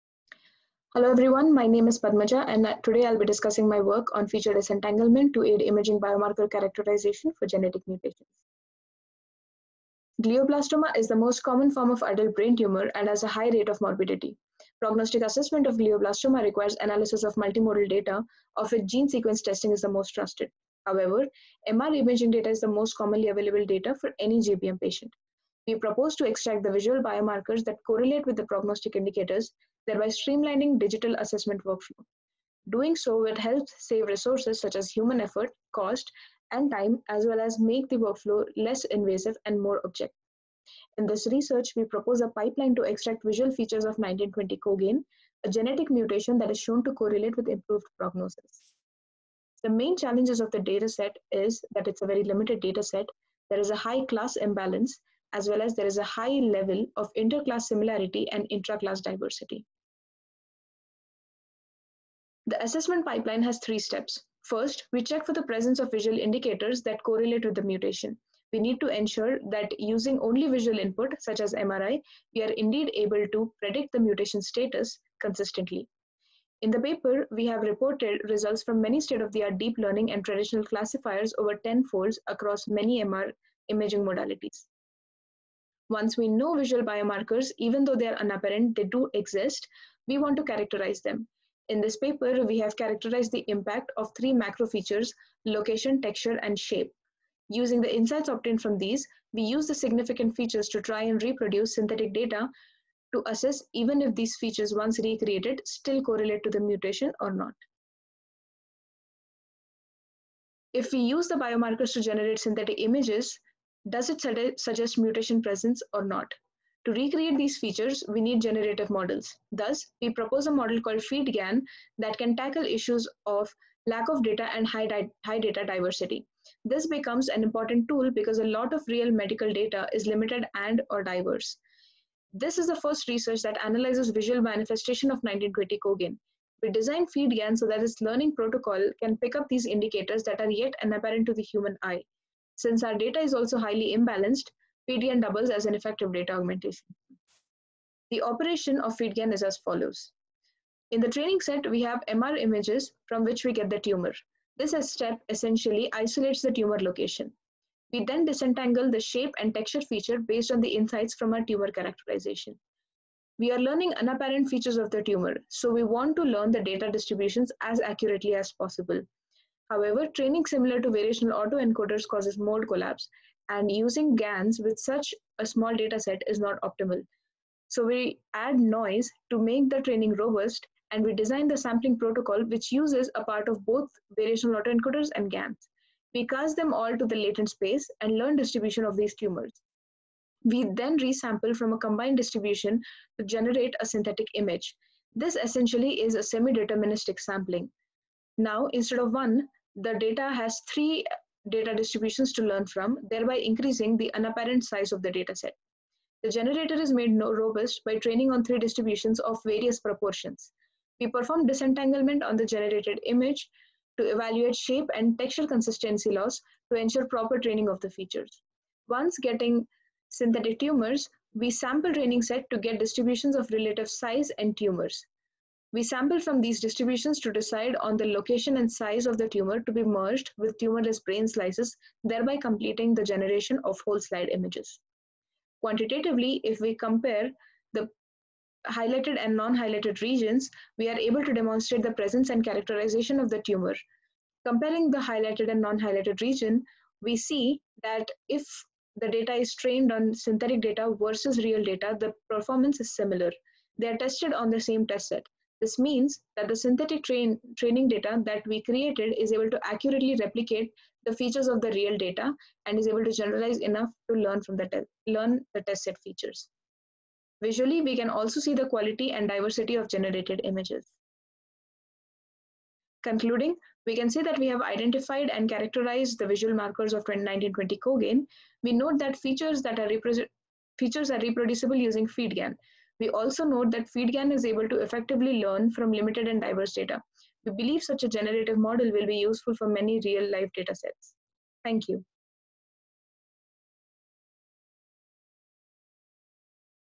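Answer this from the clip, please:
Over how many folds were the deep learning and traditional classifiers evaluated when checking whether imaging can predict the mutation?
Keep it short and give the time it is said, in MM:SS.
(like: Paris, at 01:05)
10, at 01:21.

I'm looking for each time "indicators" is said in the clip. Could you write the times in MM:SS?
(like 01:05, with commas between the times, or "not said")
00:28, 01:06, 02:19.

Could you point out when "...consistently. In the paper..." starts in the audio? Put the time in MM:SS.
01:15.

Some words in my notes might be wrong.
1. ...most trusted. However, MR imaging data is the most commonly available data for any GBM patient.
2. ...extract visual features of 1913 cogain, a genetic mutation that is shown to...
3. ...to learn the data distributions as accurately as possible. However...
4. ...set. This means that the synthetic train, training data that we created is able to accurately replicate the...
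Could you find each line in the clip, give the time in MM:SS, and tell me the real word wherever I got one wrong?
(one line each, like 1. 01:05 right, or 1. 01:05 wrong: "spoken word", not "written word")
1. 00:19 right
2. 00:42 wrong: "1920", not "1913"
3. 02:46 right
4. 04:15 right.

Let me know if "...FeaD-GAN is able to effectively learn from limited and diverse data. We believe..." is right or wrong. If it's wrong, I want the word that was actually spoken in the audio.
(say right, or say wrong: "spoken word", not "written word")
right.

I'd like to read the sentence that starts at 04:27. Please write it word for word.
Visually, we can also see the quality and diversity of generated images.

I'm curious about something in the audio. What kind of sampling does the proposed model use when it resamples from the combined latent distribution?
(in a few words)
semi-deterministic sampling.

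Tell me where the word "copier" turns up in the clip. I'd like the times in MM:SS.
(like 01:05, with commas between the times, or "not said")
not said.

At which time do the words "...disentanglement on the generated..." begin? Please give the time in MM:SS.
03:31.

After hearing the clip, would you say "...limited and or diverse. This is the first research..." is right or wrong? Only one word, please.
right.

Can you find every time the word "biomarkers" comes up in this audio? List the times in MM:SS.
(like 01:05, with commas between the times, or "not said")
00:06, 00:27, 01:26, 01:51.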